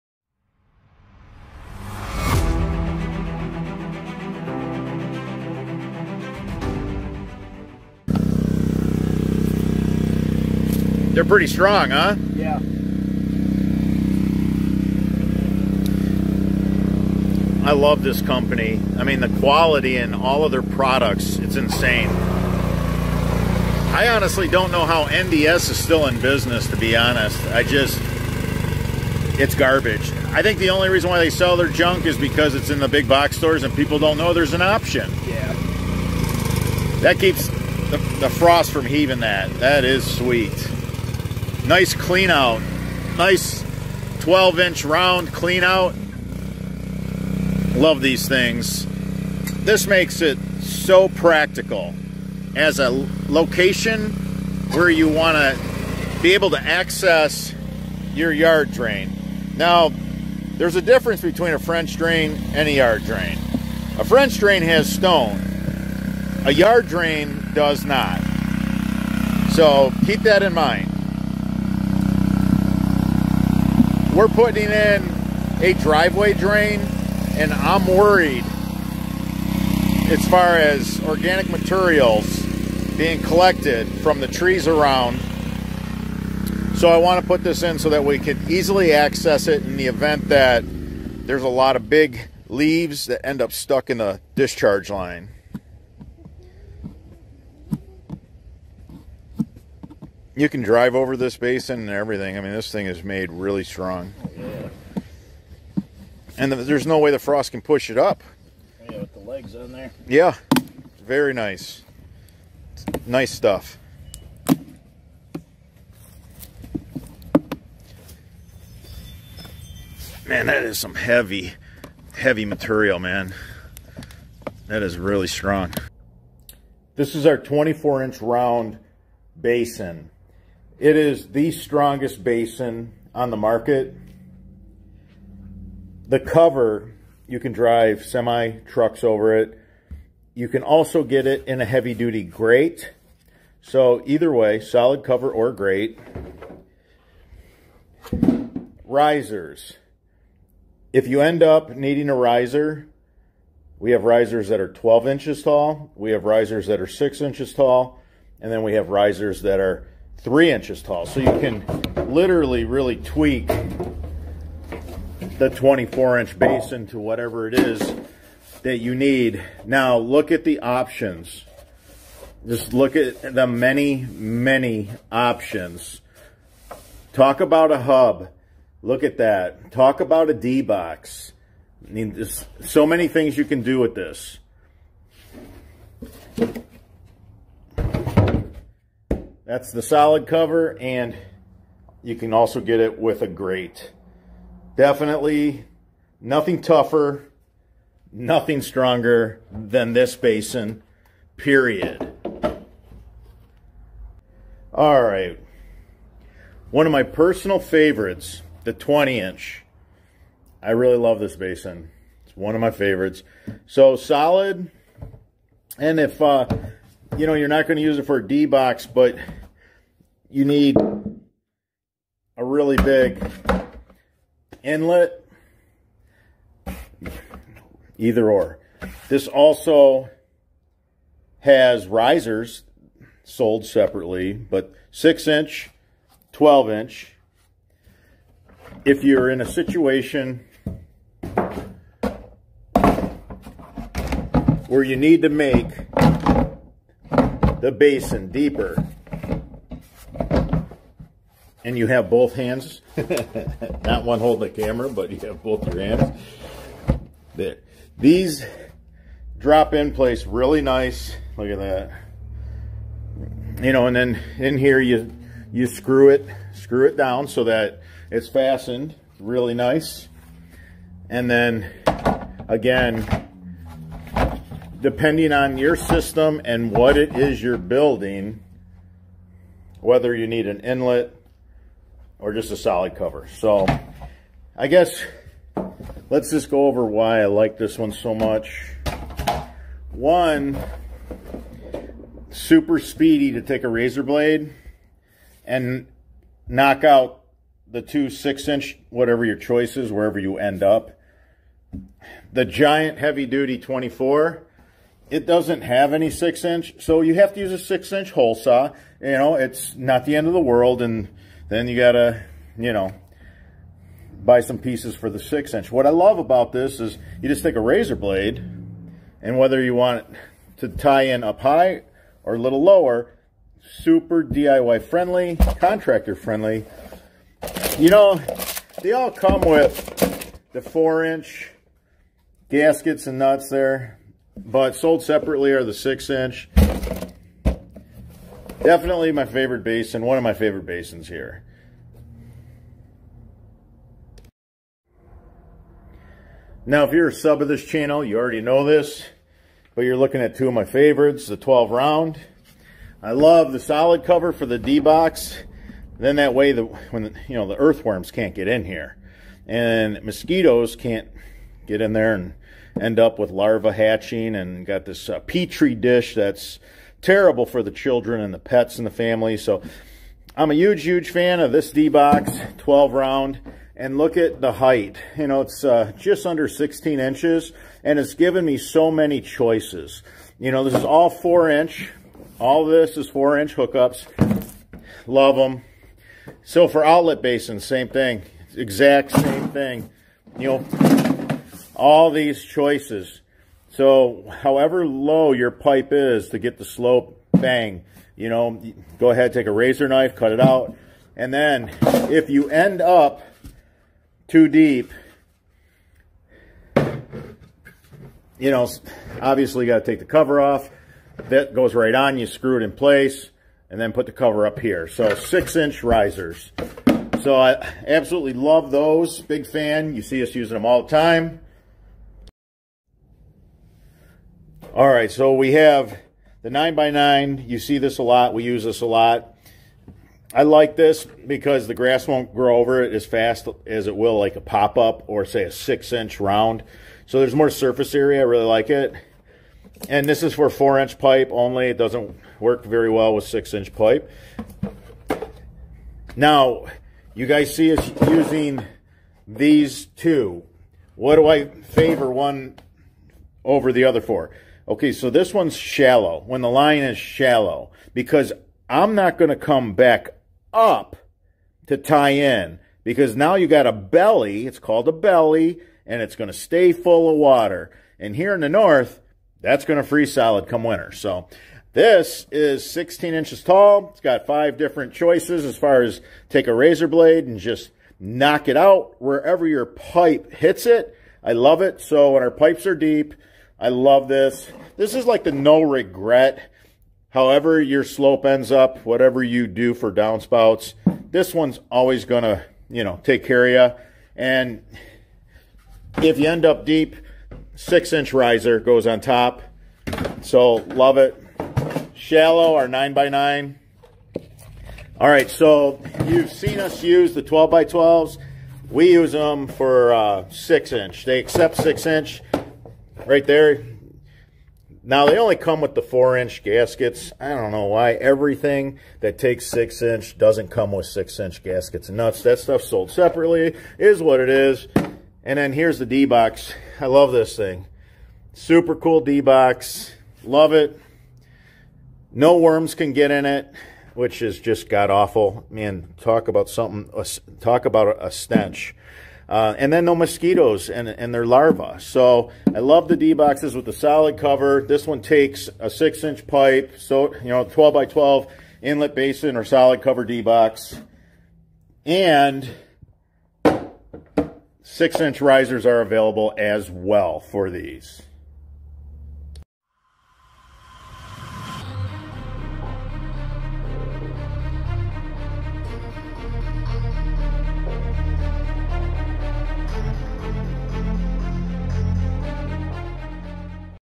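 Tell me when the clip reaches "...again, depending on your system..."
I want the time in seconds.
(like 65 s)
272 s.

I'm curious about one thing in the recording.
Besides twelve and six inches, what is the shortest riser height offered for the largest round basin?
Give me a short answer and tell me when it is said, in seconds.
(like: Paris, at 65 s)
3 inches, at 160 s.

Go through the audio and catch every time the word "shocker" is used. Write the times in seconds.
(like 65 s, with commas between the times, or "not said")
not said.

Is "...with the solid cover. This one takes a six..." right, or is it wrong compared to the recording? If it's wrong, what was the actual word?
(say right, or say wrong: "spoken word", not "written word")
right.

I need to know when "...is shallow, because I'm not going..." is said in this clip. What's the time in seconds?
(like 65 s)
456 s.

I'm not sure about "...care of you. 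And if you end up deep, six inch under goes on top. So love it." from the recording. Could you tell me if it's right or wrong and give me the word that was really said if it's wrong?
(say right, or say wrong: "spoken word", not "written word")
wrong: "riser", not "under".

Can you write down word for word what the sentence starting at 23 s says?
I honestly don't know how NDS is still in business, to be honest.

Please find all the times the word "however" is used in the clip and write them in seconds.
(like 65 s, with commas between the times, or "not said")
394 s, 487 s.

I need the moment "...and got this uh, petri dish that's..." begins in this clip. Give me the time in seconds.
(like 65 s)
364 s.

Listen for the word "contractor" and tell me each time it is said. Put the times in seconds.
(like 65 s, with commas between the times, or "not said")
325 s.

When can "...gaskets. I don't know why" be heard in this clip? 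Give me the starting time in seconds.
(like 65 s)
516 s.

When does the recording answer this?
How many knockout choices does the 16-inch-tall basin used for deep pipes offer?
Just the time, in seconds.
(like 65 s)
474 s.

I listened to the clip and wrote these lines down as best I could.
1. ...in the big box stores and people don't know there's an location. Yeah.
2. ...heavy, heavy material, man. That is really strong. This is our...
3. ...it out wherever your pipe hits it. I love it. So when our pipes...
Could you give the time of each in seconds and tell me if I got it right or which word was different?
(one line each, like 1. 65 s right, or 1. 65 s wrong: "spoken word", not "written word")
1. 32 s wrong: "option", not "location"
2. 120 s right
3. 478 s right.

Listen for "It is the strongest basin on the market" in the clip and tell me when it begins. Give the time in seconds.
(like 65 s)
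130 s.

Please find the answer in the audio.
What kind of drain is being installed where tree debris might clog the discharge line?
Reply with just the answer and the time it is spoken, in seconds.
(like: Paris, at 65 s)
driveway drain, at 75 s.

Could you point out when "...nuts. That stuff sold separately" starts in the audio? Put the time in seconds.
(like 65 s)
521 s.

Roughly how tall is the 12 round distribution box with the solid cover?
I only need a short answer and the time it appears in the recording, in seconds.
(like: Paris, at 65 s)
just under 16 inches, at 375 s.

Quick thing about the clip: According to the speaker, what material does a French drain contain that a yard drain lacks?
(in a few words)
stone.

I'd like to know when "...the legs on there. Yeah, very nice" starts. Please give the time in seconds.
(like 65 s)
109 s.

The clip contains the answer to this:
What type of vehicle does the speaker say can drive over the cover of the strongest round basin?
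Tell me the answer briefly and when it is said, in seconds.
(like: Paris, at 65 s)
semi trucks, at 138 s.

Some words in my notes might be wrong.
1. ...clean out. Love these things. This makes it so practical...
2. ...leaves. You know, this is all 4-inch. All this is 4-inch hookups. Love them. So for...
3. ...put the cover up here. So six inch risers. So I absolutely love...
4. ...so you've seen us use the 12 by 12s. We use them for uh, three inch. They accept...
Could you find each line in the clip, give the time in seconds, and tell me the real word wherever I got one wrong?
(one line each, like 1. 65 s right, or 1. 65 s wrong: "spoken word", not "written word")
1. 45 s right
2. 379 s wrong: "choices", not "leaves"
3. 413 s right
4. 505 s wrong: "six", not "three".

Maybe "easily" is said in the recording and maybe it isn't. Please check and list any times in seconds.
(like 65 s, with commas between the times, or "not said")
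88 s.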